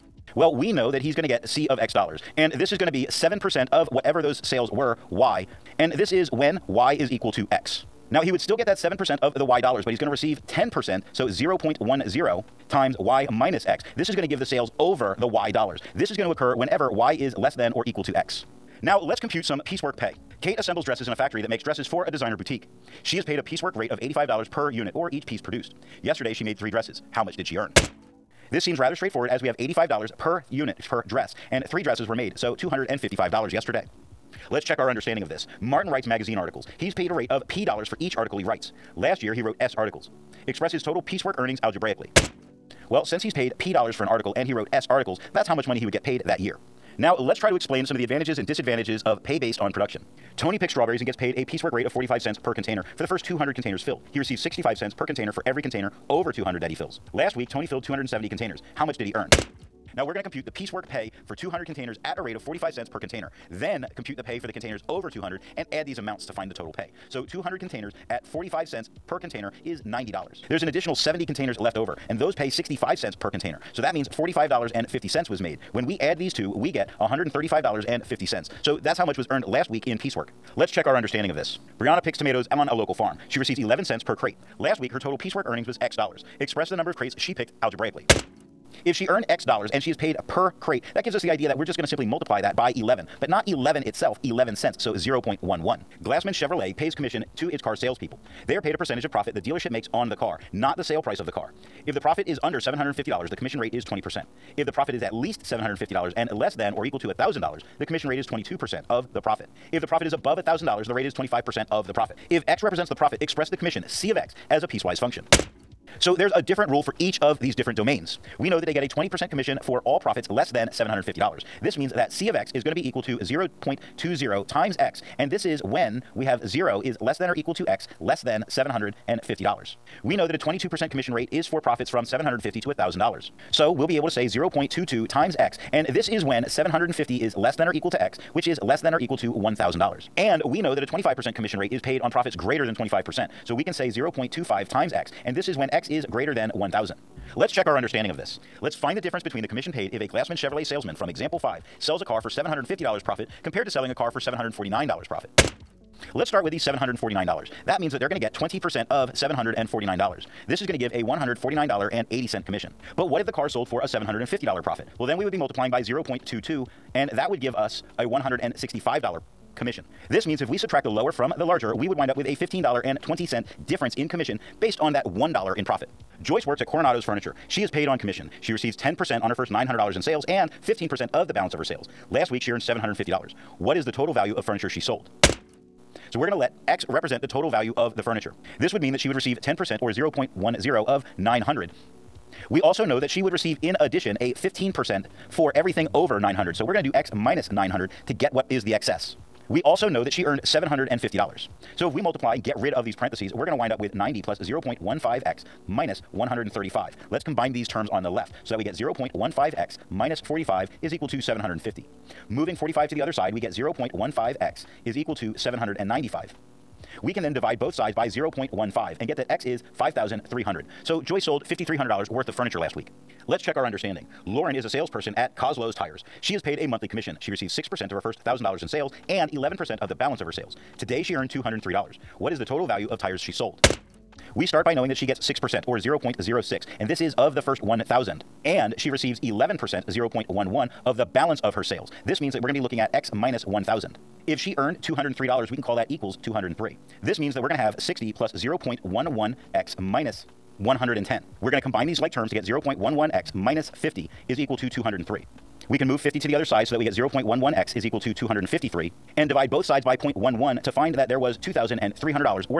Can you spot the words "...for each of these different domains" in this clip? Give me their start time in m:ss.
1:56.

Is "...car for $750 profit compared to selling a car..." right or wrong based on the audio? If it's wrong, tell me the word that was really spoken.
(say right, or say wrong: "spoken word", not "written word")
right.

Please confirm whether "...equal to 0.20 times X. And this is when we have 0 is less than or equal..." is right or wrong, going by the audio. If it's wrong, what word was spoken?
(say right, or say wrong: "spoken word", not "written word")
right.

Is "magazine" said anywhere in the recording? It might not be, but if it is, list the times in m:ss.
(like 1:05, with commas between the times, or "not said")
0:36.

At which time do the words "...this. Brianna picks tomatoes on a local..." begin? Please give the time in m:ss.
1:21.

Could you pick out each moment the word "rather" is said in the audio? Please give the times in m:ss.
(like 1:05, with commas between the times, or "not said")
0:28.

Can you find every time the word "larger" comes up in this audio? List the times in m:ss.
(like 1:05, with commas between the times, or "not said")
2:51.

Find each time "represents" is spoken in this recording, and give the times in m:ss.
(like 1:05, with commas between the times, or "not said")
1:52, 3:06.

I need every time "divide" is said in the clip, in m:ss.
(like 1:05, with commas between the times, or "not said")
3:37, 4:19.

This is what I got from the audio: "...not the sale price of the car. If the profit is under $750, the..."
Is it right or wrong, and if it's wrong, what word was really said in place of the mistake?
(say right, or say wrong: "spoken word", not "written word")
right.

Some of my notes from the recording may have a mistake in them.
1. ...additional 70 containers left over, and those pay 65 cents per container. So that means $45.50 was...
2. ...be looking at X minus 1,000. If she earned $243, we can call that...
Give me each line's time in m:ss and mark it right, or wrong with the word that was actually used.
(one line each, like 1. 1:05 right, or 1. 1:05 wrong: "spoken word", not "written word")
1. 1:10 right
2. 4:02 wrong: "203", not "243".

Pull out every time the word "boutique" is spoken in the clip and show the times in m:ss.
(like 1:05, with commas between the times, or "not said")
0:22.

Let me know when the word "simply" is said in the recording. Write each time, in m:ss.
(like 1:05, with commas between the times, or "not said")
1:31.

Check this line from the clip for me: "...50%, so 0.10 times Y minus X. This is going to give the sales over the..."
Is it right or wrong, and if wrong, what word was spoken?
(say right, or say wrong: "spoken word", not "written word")
wrong: "10", not "50".